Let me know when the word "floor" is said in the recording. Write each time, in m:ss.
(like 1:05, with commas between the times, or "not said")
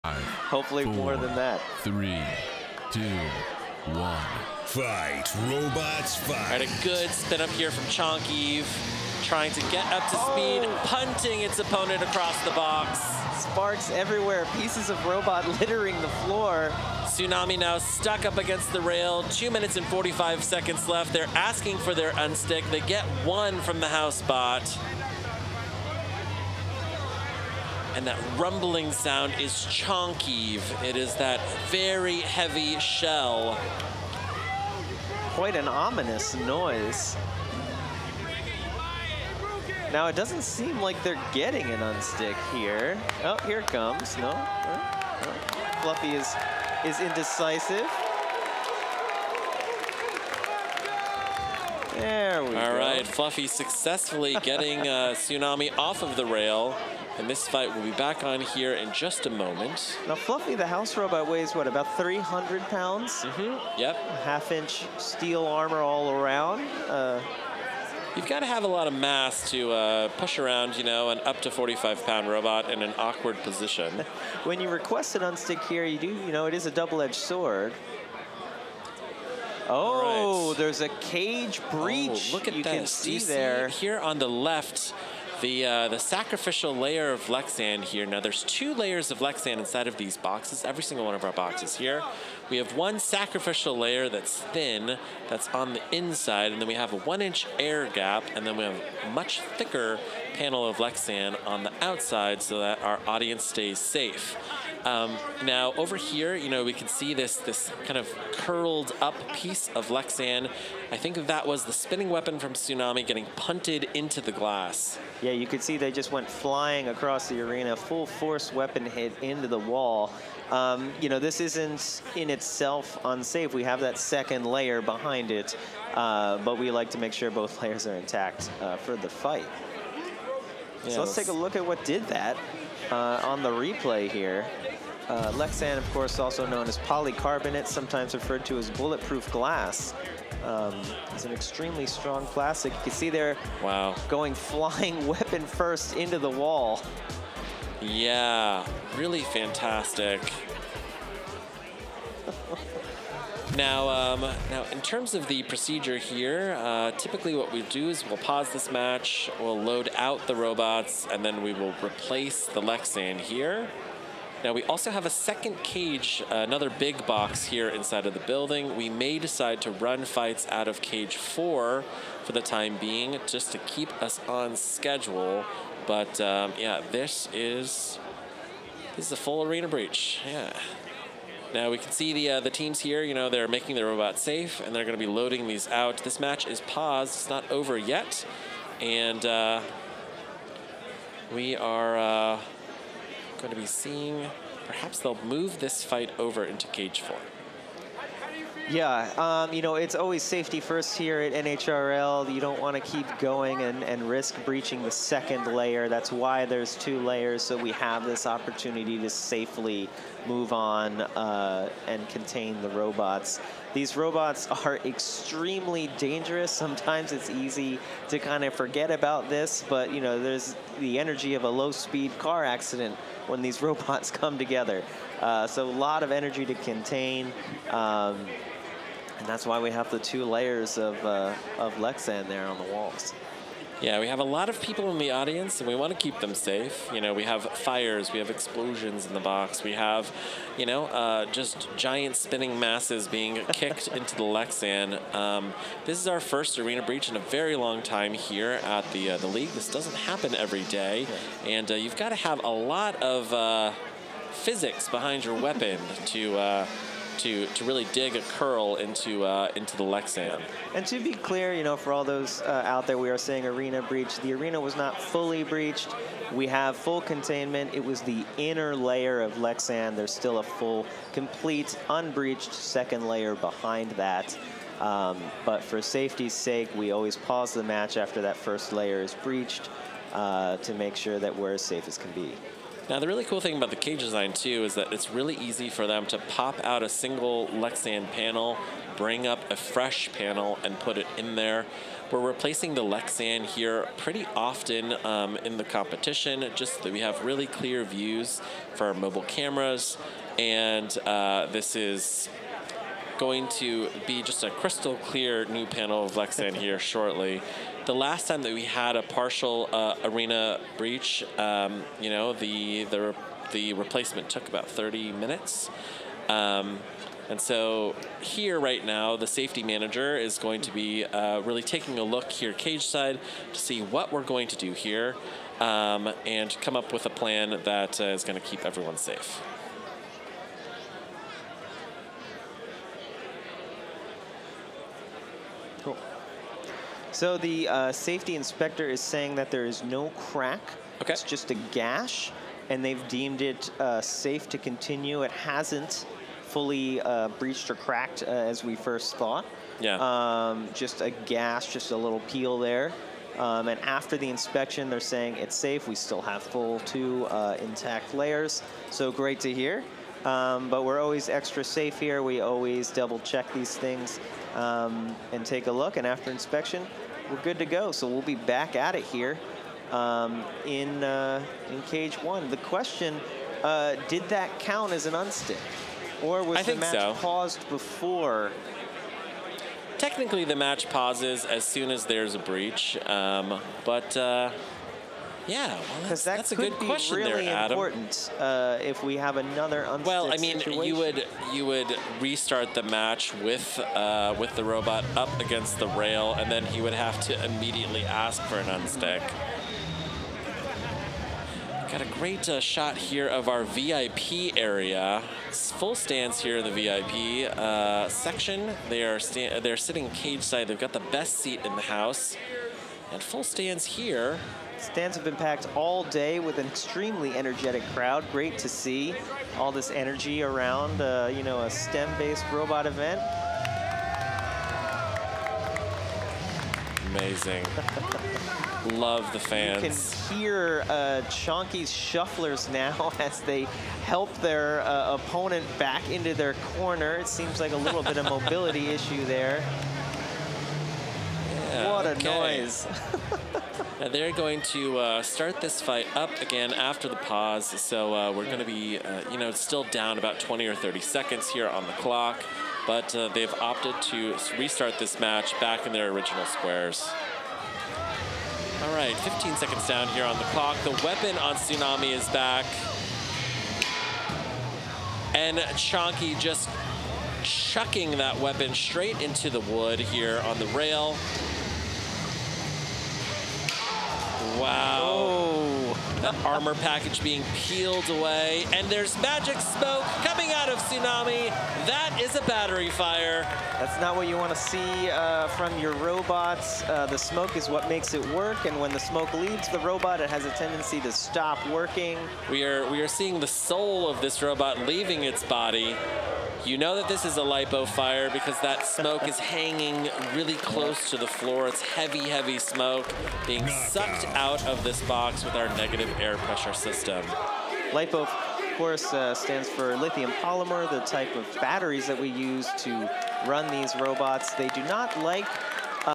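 0:16, 8:21.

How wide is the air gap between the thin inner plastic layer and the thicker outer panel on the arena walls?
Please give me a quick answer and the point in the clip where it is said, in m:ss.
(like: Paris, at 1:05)
1 inch, at 1:36.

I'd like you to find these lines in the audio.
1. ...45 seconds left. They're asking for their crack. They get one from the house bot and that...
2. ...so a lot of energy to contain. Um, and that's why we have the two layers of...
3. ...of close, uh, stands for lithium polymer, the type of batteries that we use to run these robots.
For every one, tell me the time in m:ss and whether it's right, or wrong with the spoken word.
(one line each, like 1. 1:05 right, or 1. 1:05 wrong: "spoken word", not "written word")
1. 0:19 wrong: "unstick", not "crack"
2. 3:45 right
3. 8:28 wrong: "course", not "close".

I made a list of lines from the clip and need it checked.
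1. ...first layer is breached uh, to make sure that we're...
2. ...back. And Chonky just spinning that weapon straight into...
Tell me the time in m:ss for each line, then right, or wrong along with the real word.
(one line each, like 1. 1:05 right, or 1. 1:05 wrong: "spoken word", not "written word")
1. 4:38 right
2. 7:42 wrong: "chucking", not "spinning".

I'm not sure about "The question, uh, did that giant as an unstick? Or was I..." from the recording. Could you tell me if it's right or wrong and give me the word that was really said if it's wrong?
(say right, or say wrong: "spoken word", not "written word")
wrong: "count", not "giant".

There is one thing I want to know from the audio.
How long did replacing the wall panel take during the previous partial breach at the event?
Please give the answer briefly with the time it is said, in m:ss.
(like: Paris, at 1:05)
30 minutes, at 5:14.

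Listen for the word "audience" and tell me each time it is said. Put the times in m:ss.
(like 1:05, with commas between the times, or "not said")
1:43, 3:55.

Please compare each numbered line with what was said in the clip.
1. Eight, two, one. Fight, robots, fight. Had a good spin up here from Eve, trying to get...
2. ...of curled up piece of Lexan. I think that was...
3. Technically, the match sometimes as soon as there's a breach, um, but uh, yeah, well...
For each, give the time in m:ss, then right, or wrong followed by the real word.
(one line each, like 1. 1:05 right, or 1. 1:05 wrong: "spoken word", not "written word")
1. 0:01 wrong: "Three", not "Eight"
2. 1:47 right
3. 6:19 wrong: "pauses", not "sometimes".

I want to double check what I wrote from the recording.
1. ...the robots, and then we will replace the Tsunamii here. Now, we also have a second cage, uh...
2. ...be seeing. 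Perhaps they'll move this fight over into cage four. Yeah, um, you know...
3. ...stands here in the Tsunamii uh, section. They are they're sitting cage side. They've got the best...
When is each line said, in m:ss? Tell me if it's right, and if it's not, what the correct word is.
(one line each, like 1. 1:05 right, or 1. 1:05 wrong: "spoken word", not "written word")
1. 2:40 wrong: "Lexan", not "Tsunamii"
2. 3:13 right
3. 6:45 wrong: "VIP", not "Tsunamii".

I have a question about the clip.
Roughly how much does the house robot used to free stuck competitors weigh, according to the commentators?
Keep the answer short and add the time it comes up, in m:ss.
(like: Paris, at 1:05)
300 pounds, at 1:01.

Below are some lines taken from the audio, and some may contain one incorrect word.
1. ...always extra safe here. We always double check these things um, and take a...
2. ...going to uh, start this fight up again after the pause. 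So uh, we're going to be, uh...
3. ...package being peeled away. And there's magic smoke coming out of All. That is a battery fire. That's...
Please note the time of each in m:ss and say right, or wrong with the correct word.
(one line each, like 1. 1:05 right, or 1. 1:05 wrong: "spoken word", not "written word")
1. 6:00 right
2. 7:24 right
3. 7:56 wrong: "Tsunamii", not "All".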